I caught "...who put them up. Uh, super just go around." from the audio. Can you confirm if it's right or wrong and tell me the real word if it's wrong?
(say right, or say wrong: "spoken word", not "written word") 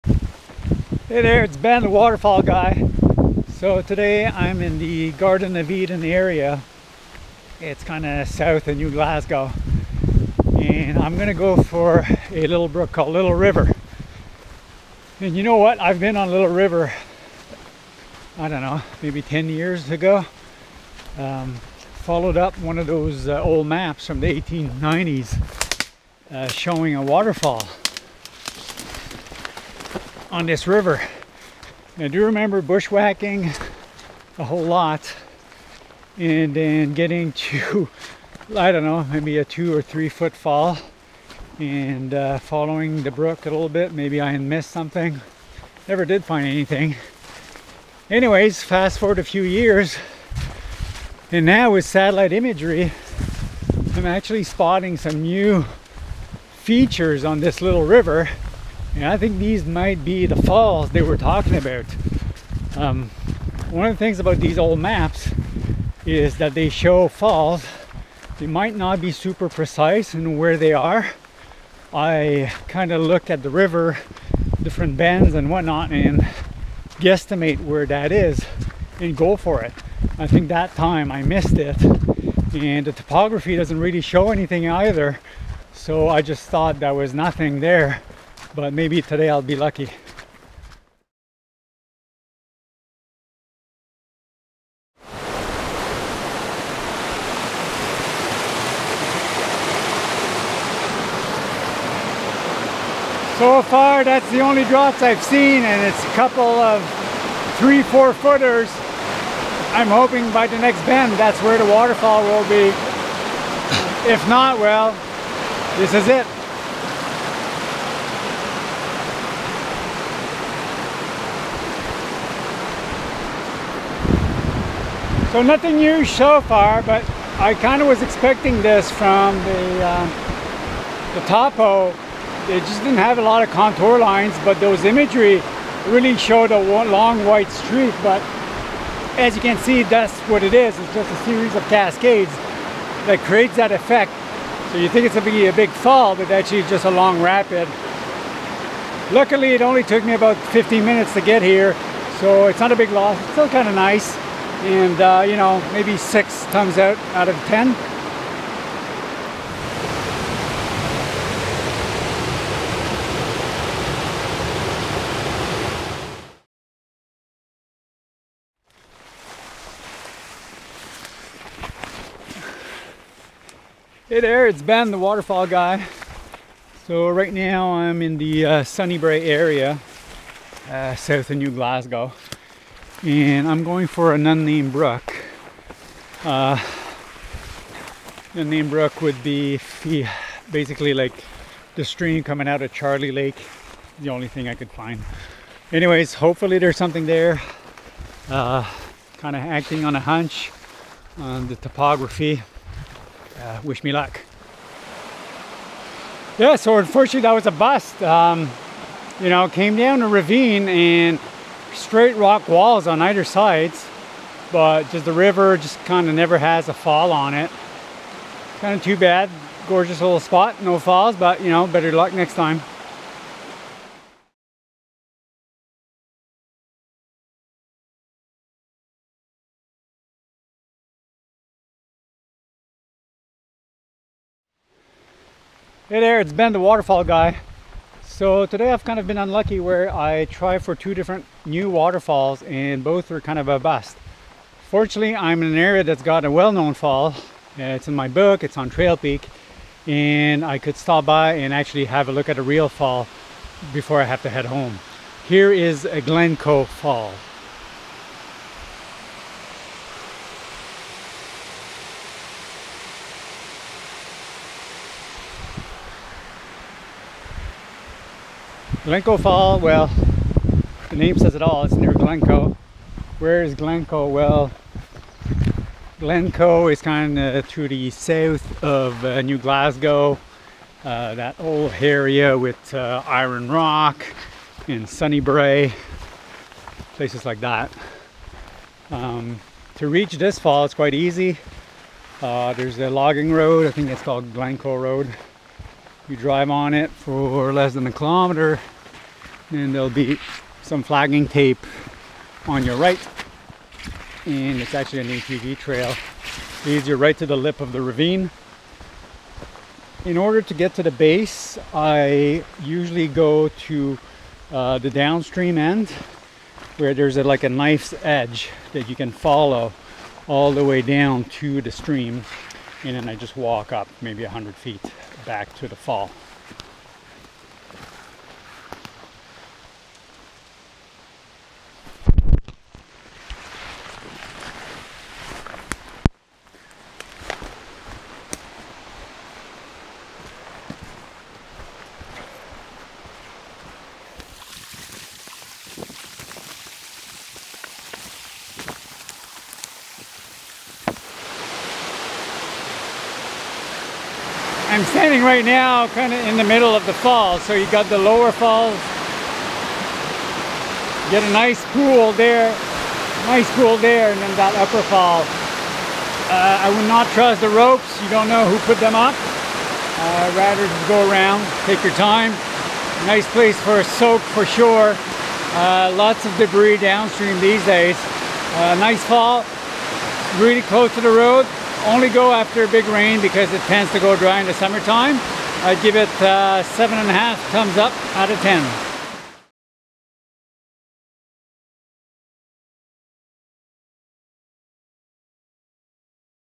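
wrong: "rather", not "super".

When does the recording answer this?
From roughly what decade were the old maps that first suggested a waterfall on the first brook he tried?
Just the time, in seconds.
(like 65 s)
24 s.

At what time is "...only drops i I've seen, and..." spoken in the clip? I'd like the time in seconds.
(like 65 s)
104 s.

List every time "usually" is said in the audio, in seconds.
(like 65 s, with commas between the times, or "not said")
312 s.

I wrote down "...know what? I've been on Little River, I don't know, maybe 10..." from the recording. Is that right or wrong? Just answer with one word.
right.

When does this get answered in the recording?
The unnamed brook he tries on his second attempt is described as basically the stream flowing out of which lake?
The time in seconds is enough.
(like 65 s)
192 s.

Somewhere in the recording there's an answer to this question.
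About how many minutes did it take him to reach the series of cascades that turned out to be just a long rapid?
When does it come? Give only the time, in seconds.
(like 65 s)
150 s.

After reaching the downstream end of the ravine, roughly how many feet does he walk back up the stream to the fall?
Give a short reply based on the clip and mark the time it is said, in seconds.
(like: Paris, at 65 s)
100 feet, at 324 s.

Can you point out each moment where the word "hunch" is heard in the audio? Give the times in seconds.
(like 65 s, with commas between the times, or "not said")
199 s.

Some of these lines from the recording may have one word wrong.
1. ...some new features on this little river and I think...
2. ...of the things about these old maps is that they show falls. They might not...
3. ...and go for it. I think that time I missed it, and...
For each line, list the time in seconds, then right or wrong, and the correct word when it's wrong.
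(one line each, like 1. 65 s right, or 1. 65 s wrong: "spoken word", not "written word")
1. 54 s right
2. 63 s right
3. 78 s right.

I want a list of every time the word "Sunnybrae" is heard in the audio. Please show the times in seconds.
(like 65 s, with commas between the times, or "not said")
178 s, 284 s.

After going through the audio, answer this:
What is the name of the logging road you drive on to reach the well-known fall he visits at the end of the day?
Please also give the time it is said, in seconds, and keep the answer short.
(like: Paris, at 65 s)
Glencoe Road, at 294 s.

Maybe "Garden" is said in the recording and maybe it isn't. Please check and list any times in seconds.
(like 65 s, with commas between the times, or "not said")
5 s.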